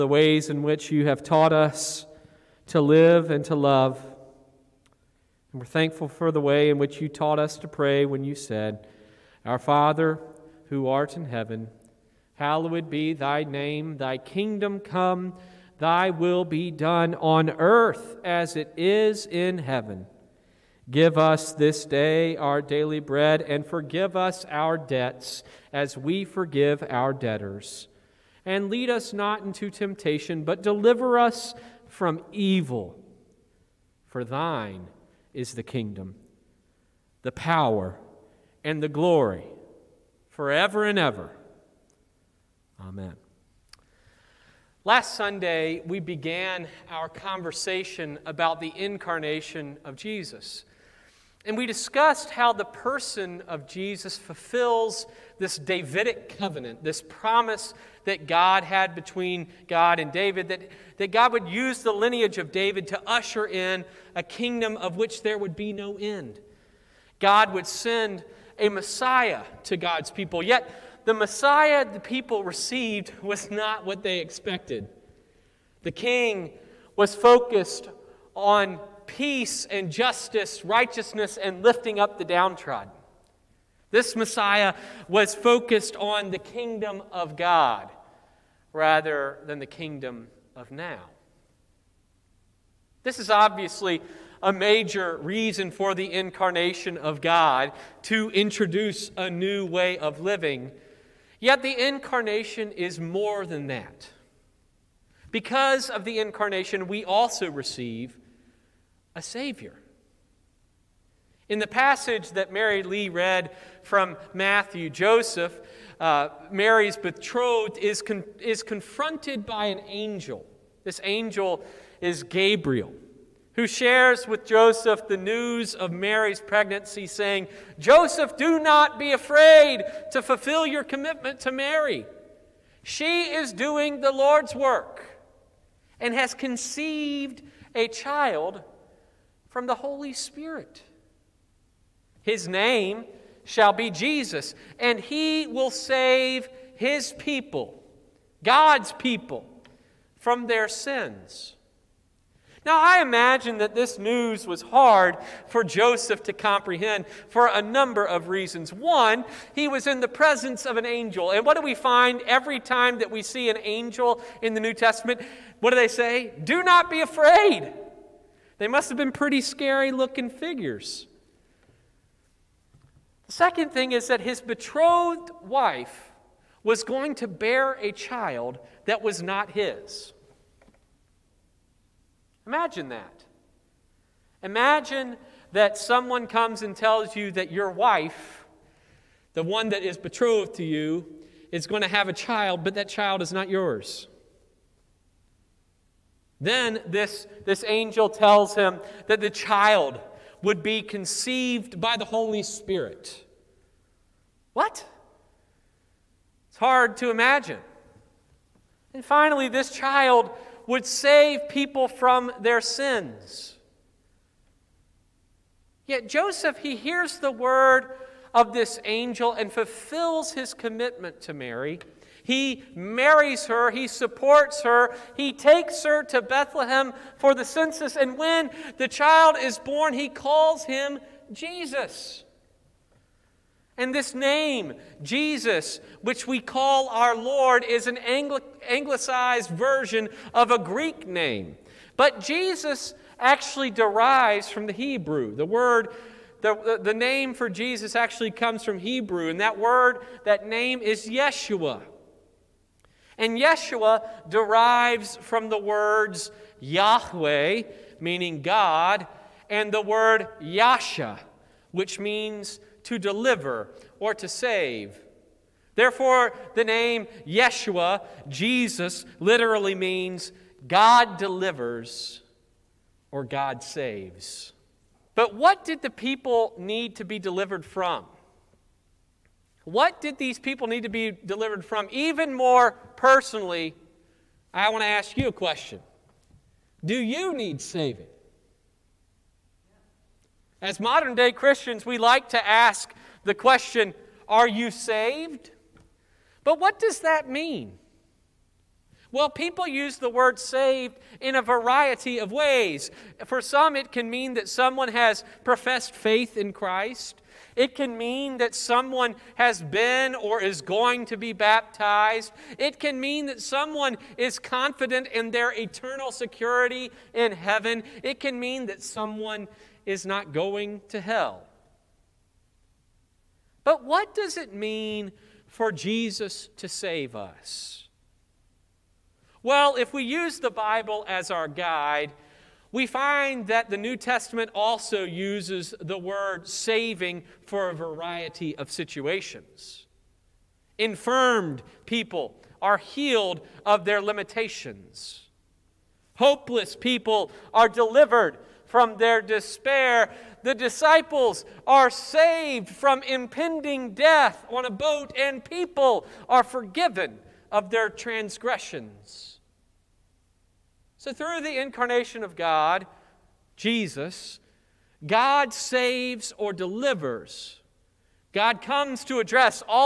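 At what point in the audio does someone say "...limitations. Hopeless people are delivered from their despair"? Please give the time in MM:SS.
05:44.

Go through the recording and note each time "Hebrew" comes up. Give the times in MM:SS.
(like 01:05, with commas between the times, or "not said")
04:04, 04:08.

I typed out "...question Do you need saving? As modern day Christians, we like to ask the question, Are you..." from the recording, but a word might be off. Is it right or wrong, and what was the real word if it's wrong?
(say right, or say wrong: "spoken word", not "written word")
right.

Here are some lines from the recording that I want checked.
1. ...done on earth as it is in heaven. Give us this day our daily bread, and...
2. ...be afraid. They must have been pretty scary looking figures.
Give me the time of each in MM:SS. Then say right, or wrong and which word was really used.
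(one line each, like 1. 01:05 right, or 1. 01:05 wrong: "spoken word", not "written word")
1. 00:16 right
2. 02:46 right.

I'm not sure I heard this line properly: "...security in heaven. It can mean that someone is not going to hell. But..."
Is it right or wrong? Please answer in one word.
right.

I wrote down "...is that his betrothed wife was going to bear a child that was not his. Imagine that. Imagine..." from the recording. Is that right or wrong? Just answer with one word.
right.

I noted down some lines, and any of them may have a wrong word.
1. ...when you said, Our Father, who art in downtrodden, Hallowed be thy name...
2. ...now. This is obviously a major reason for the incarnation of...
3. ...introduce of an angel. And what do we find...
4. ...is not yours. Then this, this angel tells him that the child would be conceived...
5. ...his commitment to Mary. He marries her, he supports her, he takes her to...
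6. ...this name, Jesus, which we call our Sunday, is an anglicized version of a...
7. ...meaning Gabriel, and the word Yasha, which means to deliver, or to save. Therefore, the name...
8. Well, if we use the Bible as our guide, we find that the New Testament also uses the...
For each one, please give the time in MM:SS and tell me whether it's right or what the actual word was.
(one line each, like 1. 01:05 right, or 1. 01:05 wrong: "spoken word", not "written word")
1. 00:08 wrong: "heaven", not "downtrodden"
2. 01:30 right
3. 02:40 wrong: "presence", not "introduce"
4. 03:13 right
5. 03:40 right
6. 03:53 wrong: "Lord", not "Sunday"
7. 04:17 wrong: "God", not "Gabriel"
8. 05:29 right.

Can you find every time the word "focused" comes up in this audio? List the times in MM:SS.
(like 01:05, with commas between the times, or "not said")
01:17, 01:25.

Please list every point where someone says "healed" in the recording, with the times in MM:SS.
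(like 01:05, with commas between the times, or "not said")
05:42.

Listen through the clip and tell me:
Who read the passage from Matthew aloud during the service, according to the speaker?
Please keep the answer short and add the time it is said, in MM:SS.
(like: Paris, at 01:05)
Mary Lee, at 01:52.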